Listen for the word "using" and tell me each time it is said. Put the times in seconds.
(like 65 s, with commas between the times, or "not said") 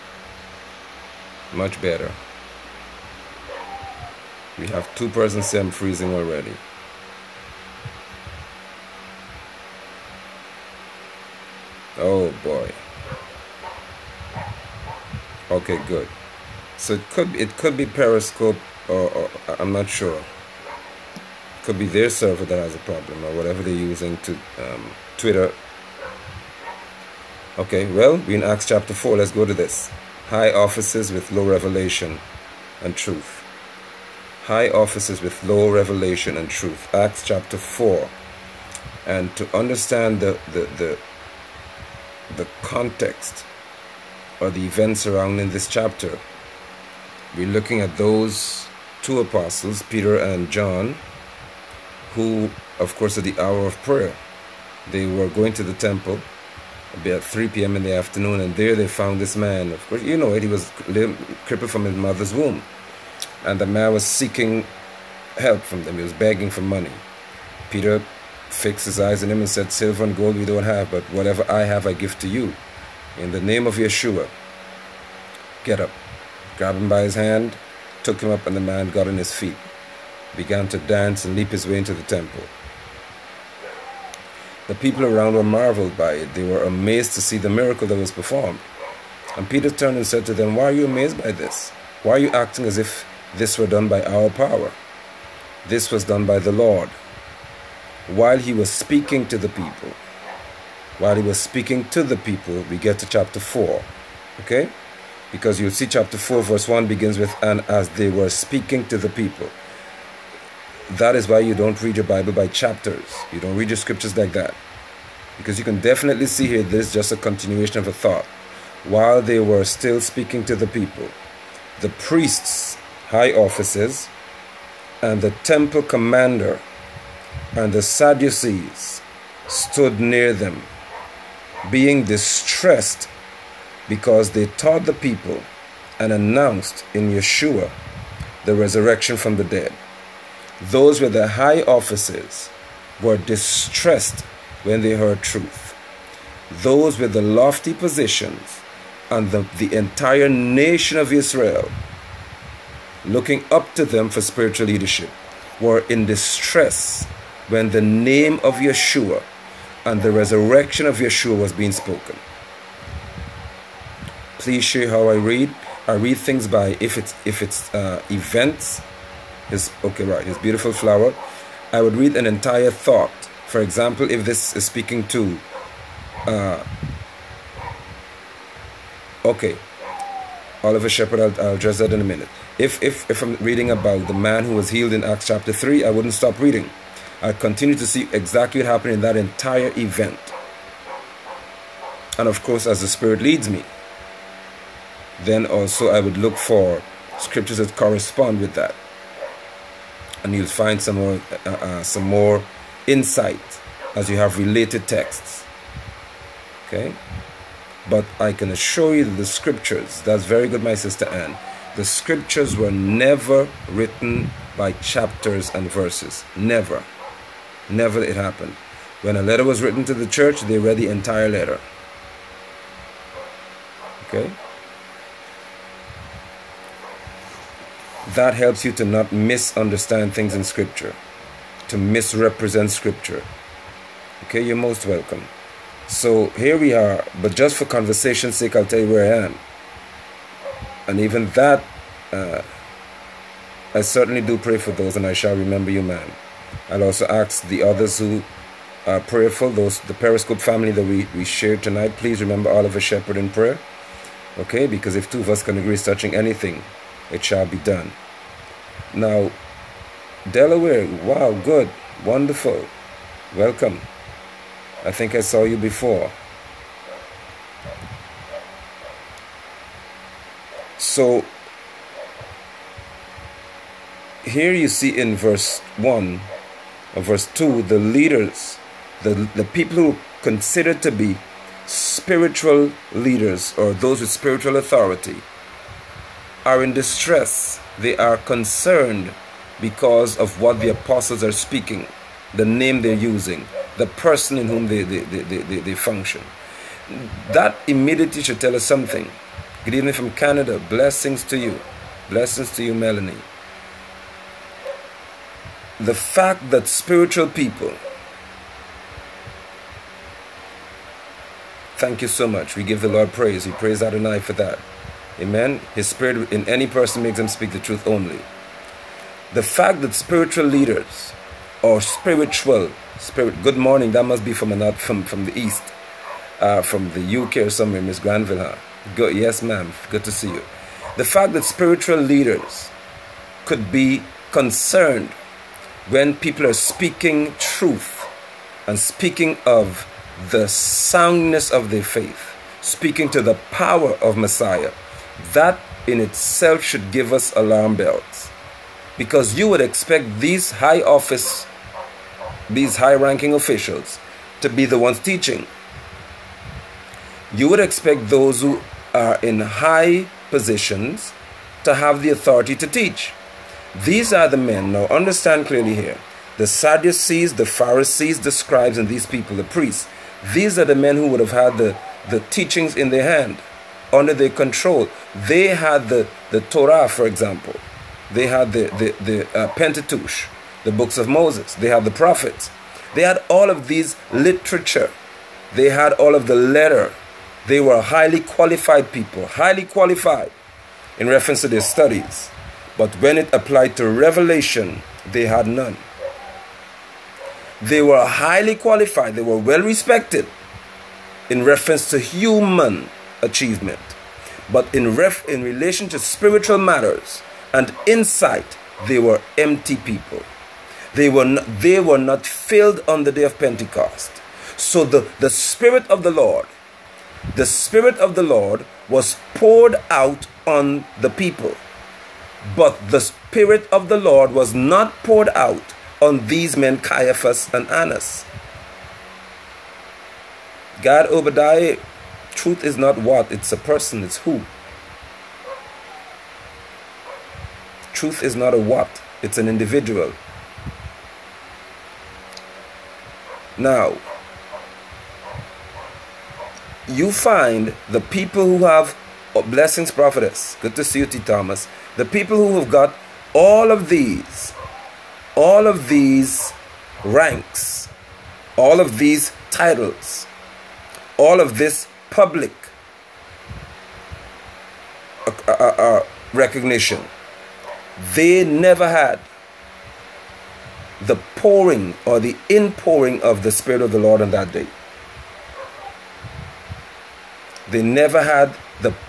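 23 s, 292 s.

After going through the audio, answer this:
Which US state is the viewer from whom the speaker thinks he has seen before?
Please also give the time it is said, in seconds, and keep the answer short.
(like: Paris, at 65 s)
Delaware, at 260 s.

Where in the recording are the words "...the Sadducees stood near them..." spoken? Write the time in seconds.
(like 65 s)
127 s.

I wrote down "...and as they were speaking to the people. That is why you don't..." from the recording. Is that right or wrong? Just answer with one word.
right.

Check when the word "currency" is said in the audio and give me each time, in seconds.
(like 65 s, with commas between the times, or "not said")
not said.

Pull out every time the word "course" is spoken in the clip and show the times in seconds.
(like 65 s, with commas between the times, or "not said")
52 s, 59 s, 192 s.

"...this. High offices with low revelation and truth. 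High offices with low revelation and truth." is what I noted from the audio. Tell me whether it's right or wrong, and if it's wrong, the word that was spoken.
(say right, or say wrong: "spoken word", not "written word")
right.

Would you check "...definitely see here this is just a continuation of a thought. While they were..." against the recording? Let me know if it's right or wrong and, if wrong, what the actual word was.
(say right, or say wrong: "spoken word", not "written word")
right.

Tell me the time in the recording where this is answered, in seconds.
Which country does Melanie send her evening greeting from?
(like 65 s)
300 s.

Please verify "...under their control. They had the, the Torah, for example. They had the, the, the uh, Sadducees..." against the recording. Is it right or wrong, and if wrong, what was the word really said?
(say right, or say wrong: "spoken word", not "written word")
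wrong: "Pentateuch", not "Sadducees".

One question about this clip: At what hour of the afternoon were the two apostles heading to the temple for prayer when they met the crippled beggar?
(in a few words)
3 p.m.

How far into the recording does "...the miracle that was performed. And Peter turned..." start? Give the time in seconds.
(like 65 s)
87 s.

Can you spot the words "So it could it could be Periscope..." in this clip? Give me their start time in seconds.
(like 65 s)
16 s.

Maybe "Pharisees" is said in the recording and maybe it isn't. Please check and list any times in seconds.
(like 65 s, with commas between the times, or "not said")
367 s.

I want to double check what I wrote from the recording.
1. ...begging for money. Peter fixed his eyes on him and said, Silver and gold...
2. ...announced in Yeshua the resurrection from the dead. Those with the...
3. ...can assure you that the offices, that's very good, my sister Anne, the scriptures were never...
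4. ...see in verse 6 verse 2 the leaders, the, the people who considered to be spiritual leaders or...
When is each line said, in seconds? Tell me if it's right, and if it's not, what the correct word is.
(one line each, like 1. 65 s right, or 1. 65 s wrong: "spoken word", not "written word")
1. 66 s right
2. 136 s right
3. 208 s wrong: "scriptures", not "offices"
4. 274 s wrong: "1", not "6".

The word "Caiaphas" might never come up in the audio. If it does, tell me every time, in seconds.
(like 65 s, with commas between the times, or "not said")
426 s.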